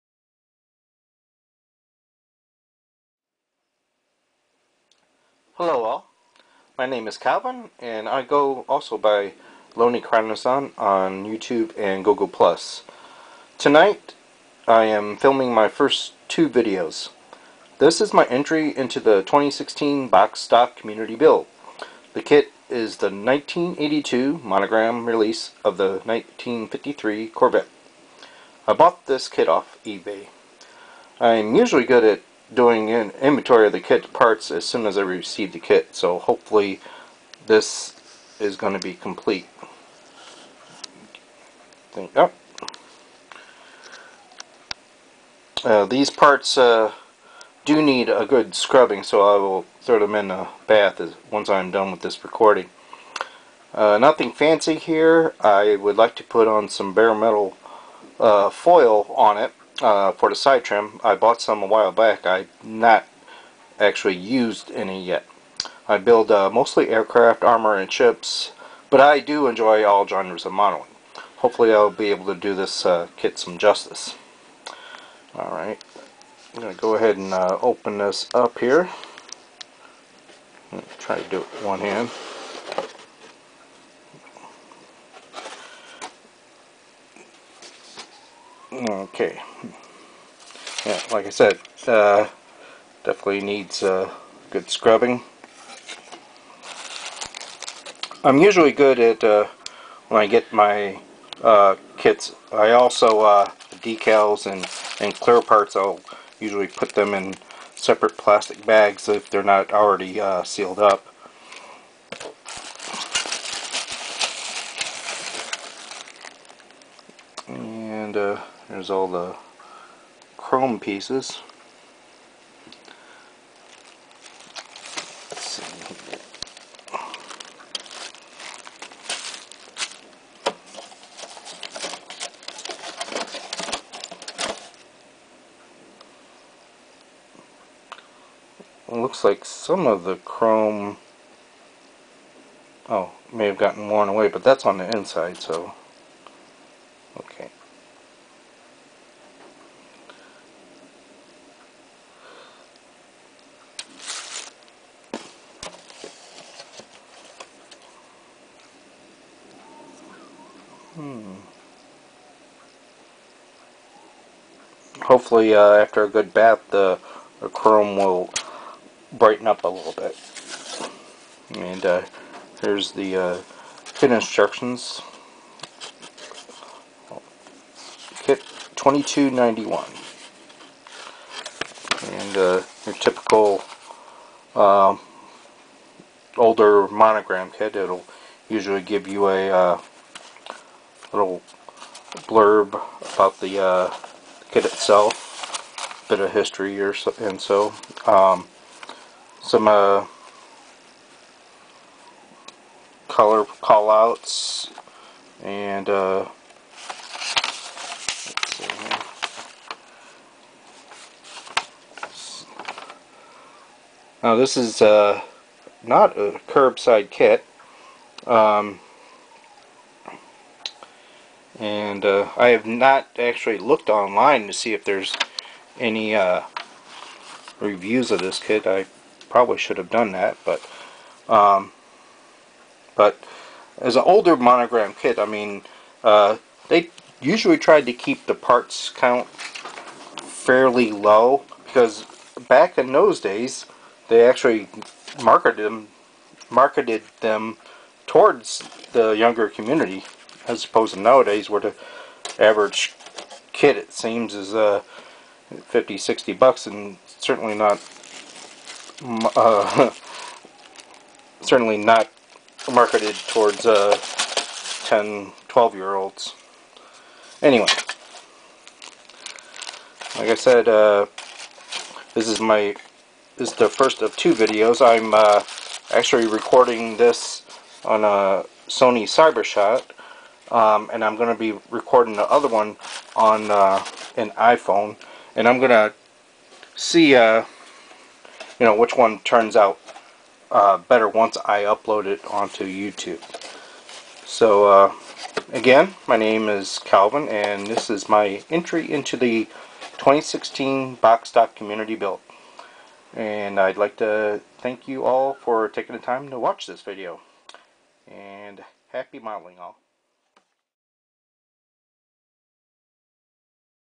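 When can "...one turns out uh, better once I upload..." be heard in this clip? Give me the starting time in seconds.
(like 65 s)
288 s.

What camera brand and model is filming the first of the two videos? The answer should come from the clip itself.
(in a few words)
Sony Cybershot.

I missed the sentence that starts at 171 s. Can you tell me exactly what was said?
And uh, here's the uh, kit instructions.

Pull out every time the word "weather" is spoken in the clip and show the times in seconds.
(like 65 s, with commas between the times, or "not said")
not said.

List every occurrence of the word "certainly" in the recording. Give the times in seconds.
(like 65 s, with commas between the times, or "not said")
257 s, 261 s.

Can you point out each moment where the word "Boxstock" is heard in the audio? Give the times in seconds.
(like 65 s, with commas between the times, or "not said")
300 s.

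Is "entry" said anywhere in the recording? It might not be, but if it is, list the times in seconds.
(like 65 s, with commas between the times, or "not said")
18 s, 298 s.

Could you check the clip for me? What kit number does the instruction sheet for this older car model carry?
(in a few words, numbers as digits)
2291.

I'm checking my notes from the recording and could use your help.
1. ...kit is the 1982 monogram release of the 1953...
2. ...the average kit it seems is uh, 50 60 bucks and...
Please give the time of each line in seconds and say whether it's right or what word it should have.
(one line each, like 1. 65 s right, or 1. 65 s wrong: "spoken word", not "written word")
1. 22 s right
2. 251 s right.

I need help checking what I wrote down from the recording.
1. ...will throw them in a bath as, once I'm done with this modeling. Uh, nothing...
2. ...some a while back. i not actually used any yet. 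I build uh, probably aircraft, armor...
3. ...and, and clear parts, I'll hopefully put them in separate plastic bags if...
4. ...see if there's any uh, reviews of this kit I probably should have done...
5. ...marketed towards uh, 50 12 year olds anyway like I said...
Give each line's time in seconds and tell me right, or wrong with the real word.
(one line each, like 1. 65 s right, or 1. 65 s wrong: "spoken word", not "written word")
1. 49 s wrong: "recording", not "modeling"
2. 61 s wrong: "mostly", not "probably"
3. 104 s wrong: "usually", not "hopefully"
4. 224 s right
5. 262 s wrong: "10", not "50".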